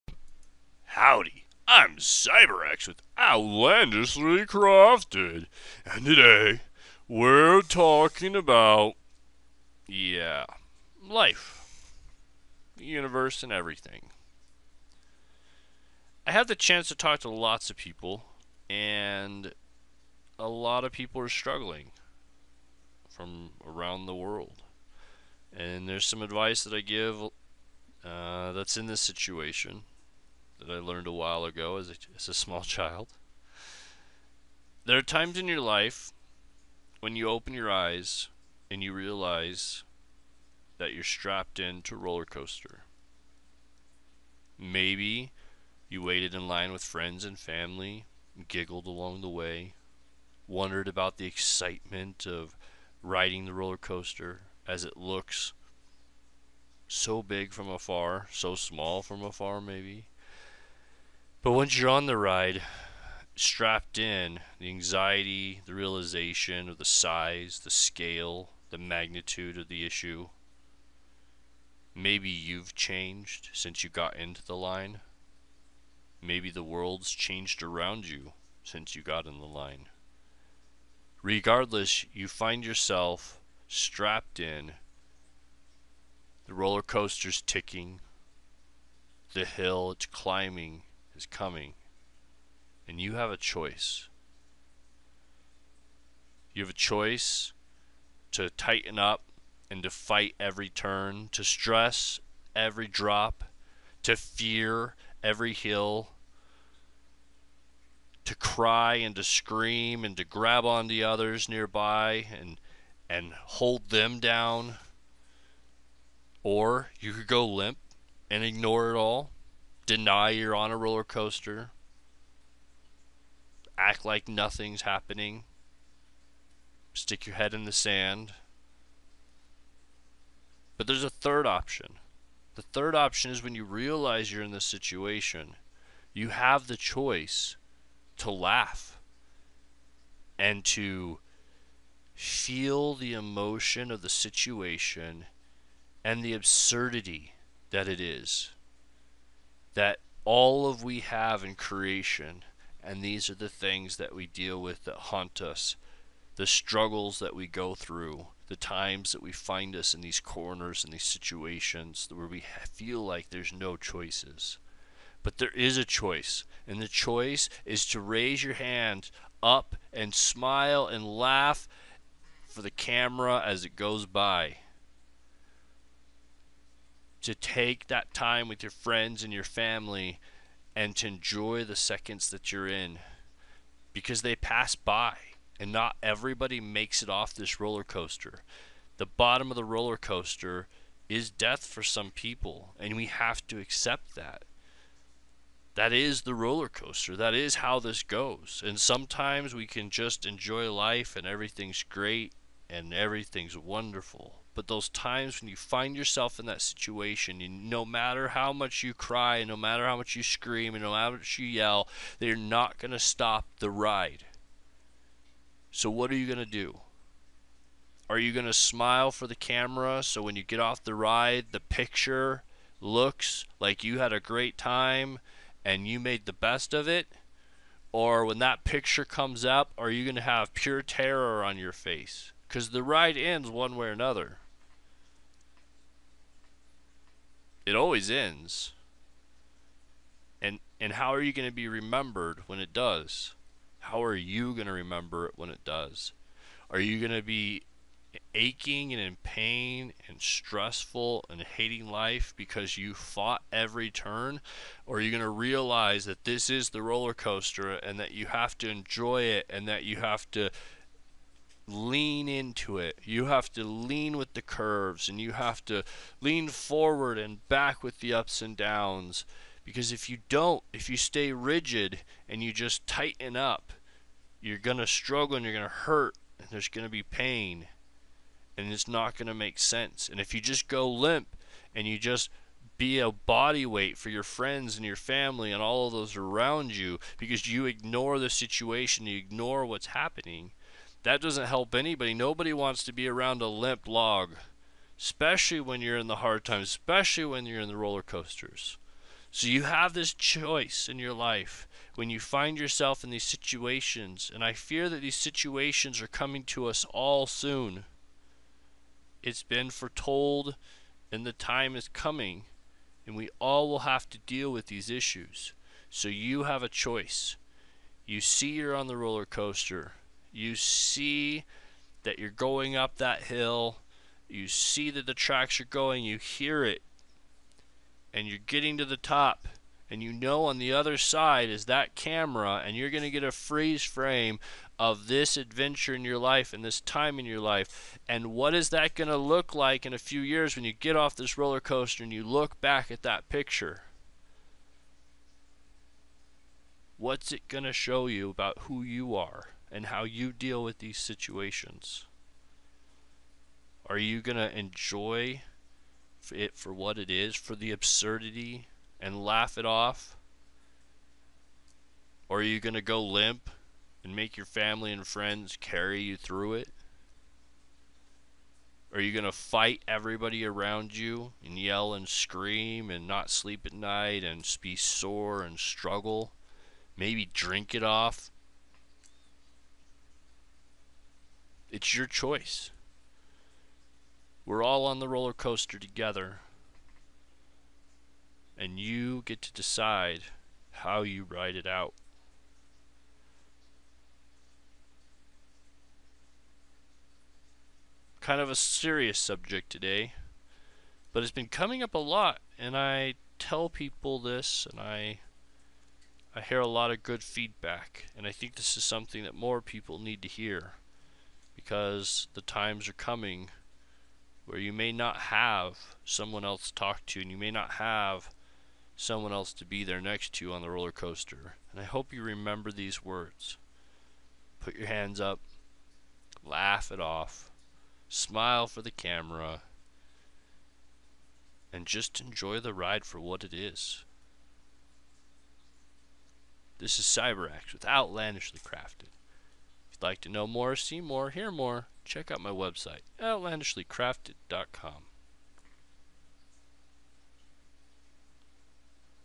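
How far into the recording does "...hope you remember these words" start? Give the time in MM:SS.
07:01.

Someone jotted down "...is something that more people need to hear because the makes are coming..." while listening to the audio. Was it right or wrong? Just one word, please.
wrong.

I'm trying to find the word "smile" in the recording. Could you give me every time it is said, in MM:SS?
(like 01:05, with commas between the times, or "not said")
02:50, 03:38, 07:08.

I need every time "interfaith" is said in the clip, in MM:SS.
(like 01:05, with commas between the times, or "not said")
not said.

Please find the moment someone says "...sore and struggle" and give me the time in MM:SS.
06:14.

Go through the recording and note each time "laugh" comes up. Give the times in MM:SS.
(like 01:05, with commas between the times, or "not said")
02:18, 02:51, 05:59, 07:06.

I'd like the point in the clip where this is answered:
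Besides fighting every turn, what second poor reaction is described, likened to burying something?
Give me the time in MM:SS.
02:06.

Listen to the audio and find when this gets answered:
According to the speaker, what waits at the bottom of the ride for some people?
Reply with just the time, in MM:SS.
03:11.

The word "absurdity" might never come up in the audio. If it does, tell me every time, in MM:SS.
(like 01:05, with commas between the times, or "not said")
02:26, 05:57.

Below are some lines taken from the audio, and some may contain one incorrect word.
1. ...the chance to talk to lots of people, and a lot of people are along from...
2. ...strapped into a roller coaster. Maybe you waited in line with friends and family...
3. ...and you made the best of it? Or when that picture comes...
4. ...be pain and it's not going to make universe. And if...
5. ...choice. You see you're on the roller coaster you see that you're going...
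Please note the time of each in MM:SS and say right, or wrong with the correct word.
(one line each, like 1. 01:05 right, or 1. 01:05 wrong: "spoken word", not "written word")
1. 00:16 wrong: "struggling", not "along"
2. 00:41 right
3. 03:45 right
4. 04:36 wrong: "sense", not "universe"
5. 05:16 right.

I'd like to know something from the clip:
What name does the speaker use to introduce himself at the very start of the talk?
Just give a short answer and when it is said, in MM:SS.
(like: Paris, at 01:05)
CyberAxe, at 00:01.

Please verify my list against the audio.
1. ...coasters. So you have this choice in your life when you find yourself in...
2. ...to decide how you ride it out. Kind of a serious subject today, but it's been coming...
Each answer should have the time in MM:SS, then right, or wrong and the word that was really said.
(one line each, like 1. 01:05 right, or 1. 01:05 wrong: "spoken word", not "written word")
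1. 04:58 right
2. 06:29 right.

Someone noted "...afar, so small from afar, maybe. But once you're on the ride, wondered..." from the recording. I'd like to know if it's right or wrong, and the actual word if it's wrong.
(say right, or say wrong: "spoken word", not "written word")
wrong: "strapped", not "wondered".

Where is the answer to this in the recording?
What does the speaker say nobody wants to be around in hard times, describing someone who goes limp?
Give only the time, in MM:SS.
04:53.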